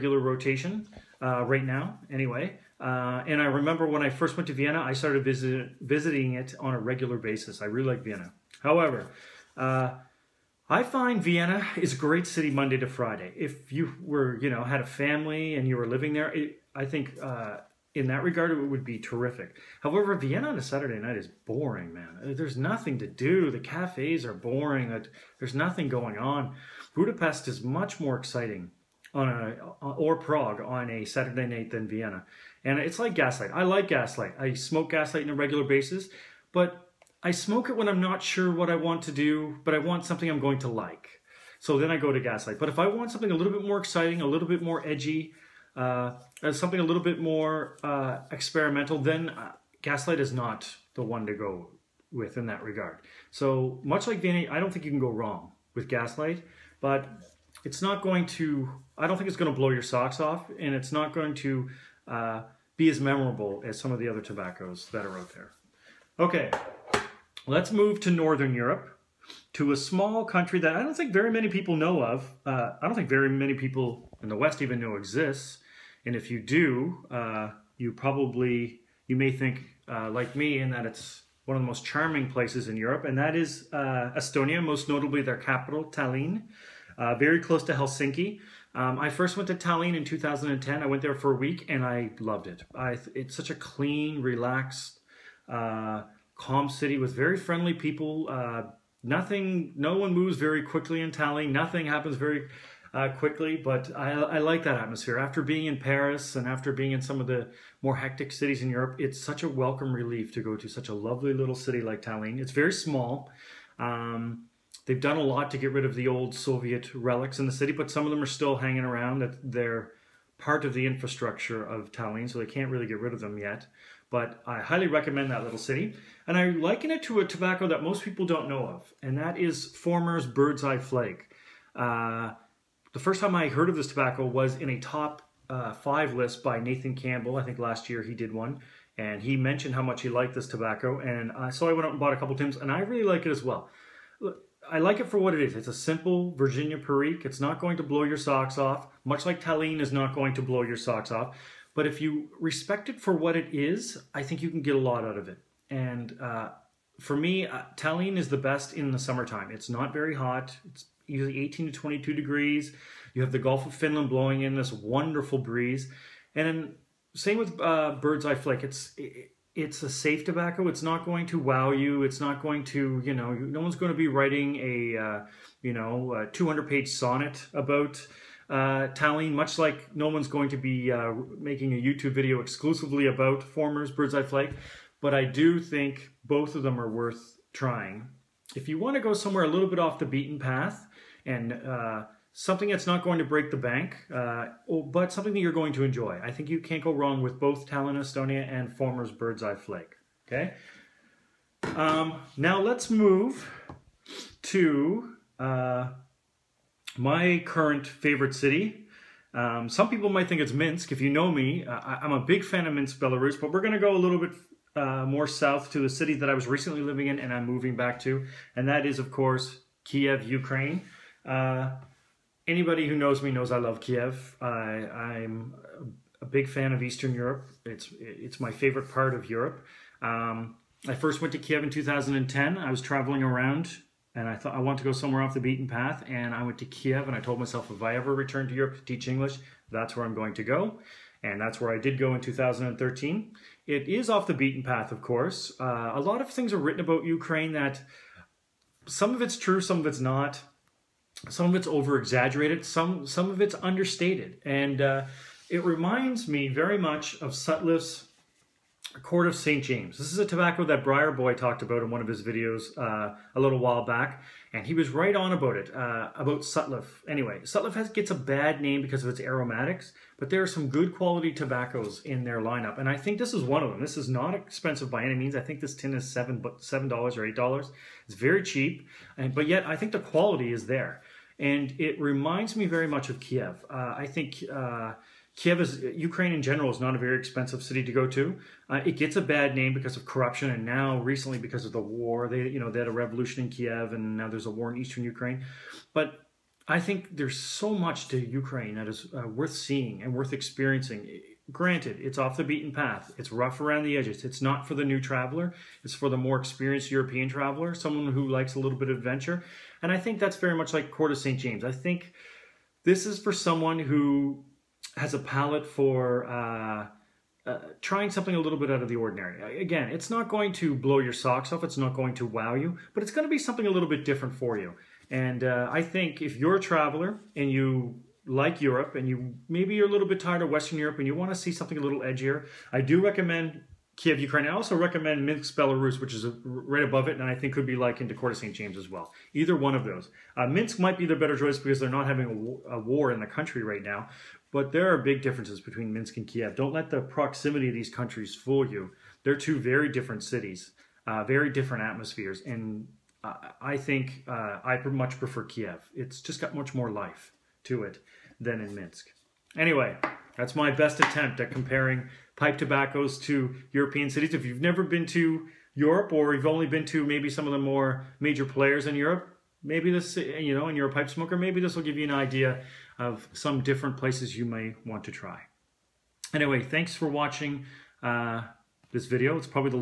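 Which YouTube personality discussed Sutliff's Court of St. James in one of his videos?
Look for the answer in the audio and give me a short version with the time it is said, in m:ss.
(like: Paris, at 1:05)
Briar Boy, at 4:20.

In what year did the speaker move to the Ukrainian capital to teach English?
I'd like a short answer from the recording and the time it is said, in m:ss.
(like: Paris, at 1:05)
2013, at 4:02.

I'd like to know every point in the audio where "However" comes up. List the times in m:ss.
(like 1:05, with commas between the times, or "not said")
0:08, 0:19.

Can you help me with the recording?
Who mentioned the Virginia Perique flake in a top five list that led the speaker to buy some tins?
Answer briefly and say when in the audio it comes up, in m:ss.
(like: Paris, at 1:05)
Nathan Campbell, at 2:16.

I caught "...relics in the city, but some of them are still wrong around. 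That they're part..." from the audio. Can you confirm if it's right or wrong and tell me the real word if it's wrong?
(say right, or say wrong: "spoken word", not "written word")
wrong: "hanging", not "wrong".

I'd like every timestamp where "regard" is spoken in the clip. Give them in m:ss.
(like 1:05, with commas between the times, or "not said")
0:18, 0:52.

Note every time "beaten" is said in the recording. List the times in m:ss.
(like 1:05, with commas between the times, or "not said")
3:10, 3:55, 4:04, 5:02.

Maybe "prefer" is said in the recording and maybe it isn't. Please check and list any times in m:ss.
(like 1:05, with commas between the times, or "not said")
5:55.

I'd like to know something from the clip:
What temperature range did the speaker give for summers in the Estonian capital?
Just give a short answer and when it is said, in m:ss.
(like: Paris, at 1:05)
18 to 22 degrees, at 2:41.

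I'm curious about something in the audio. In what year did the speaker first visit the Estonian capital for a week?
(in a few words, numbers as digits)
2010.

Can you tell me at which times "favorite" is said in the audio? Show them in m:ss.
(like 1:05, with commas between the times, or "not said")
3:27, 3:48.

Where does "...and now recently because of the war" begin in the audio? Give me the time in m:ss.
4:50.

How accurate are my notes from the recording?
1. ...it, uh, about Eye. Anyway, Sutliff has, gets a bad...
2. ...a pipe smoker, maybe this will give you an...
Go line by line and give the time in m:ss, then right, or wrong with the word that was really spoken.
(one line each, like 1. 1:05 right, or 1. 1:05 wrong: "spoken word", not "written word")
1. 4:25 wrong: "Sutliff", not "Eye"
2. 6:10 right.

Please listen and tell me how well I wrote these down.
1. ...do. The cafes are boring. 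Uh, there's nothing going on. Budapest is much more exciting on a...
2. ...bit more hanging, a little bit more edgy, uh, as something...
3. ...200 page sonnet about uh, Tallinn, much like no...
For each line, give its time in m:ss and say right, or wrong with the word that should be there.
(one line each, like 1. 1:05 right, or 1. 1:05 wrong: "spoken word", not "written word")
1. 0:23 right
2. 0:43 wrong: "exciting", not "hanging"
3. 2:56 right.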